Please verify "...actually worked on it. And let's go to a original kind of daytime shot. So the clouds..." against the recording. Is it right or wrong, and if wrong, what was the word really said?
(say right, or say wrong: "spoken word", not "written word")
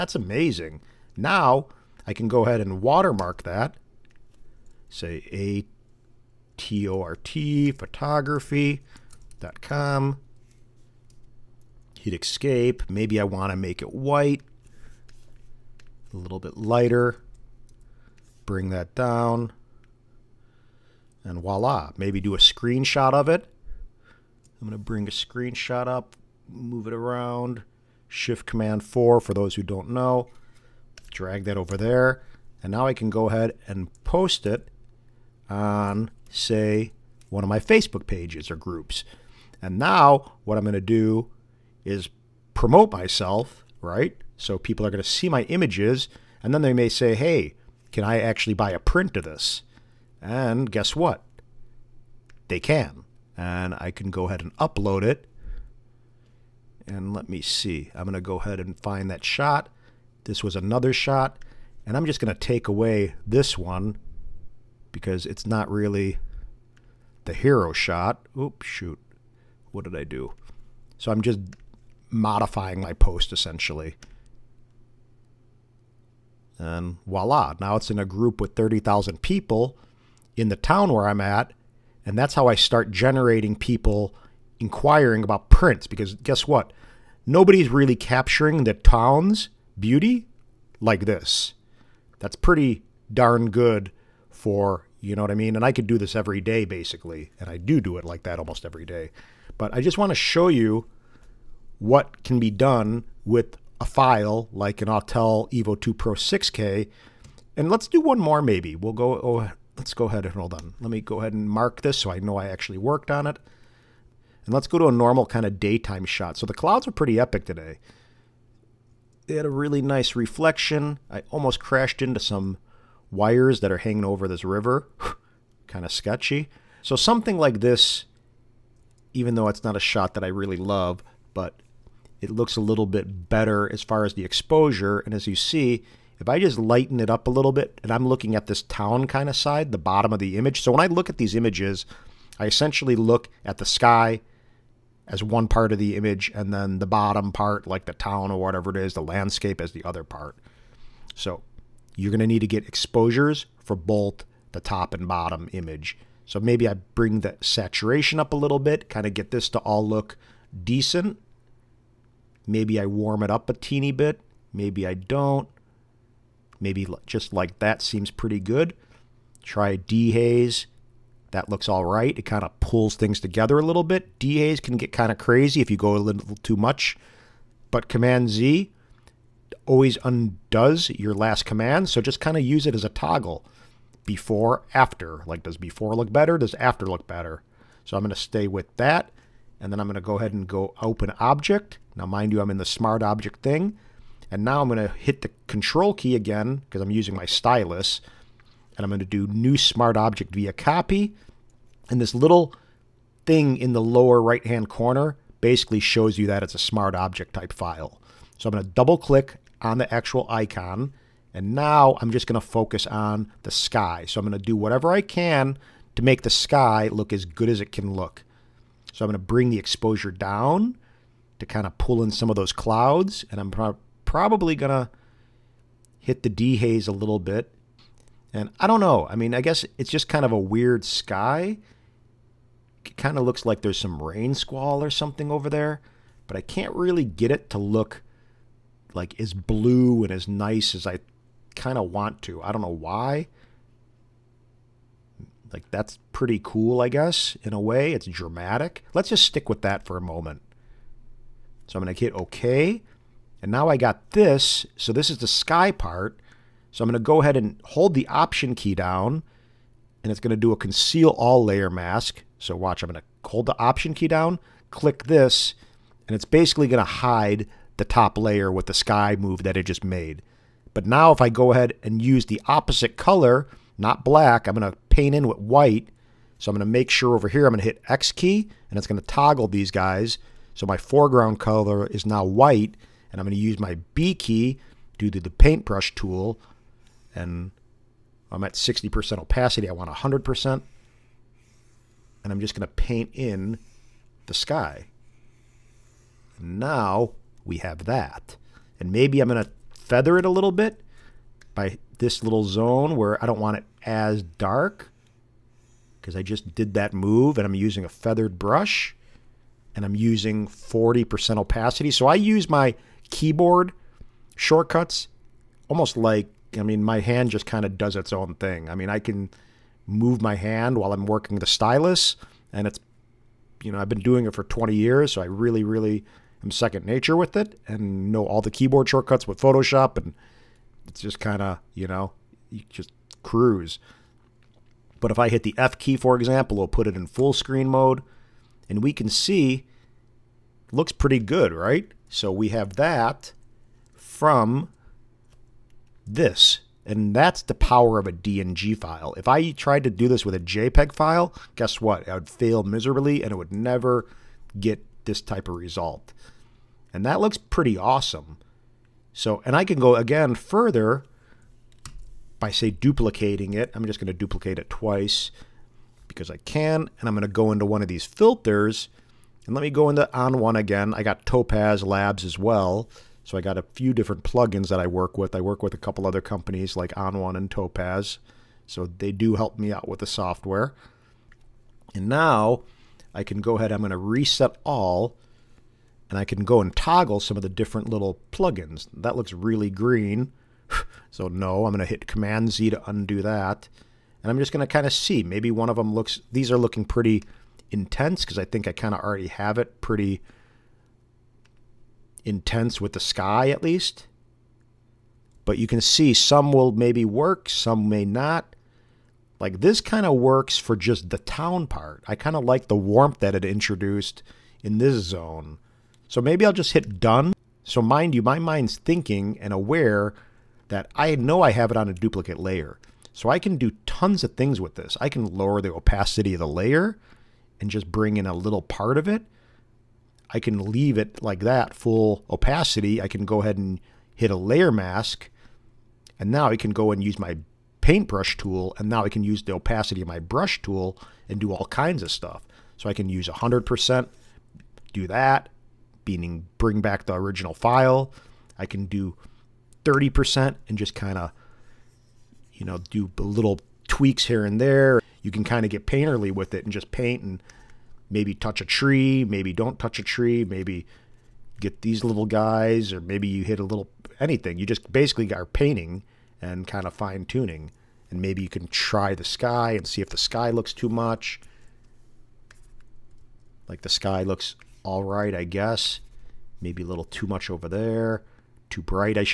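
wrong: "normal", not "original".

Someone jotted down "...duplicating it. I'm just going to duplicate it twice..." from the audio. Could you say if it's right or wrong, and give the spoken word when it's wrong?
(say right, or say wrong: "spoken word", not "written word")
right.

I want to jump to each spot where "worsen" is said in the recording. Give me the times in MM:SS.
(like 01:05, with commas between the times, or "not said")
not said.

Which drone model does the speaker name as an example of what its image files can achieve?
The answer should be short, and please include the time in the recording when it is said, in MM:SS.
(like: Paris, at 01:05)
Autel Evo 2 Pro 6K, at 01:44.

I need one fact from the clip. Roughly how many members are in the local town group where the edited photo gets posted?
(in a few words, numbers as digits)
30,000.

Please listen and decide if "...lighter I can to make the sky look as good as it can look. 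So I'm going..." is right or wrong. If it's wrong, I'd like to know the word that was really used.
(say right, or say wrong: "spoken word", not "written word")
wrong: "whatever", not "lighter".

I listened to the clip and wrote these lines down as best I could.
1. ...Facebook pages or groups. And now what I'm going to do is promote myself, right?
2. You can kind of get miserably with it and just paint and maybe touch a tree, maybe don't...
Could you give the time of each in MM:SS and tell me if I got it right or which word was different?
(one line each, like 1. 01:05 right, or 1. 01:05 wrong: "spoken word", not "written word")
1. 00:37 right
2. 07:35 wrong: "painterly", not "miserably".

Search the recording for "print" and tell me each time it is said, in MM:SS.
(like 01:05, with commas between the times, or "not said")
00:48, 01:25.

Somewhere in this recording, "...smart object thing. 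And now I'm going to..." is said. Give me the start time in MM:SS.
03:12.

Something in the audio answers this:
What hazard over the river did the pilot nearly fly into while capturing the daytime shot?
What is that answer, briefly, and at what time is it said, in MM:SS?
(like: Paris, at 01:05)
wires, at 02:03.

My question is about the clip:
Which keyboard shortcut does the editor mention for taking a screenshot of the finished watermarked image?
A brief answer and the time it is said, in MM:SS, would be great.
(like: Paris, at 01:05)
Shift Command 4, at 00:28.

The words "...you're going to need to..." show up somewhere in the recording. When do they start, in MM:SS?
02:31.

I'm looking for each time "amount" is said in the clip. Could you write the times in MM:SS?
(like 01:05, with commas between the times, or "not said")
not said.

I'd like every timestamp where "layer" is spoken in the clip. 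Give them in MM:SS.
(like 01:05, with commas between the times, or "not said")
04:21, 04:28, 07:02, 07:06, 07:14.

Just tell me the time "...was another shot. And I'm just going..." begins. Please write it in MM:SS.
01:00.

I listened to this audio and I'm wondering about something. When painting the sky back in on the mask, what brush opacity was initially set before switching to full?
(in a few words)
60%.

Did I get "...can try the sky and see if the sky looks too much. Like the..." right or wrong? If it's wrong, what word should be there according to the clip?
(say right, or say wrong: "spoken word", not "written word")
right.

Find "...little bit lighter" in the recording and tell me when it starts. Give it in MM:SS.
00:16.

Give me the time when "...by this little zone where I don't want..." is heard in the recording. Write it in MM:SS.
05:01.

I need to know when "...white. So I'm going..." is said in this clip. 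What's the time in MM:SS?
04:35.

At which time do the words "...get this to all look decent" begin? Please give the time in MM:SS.
02:39.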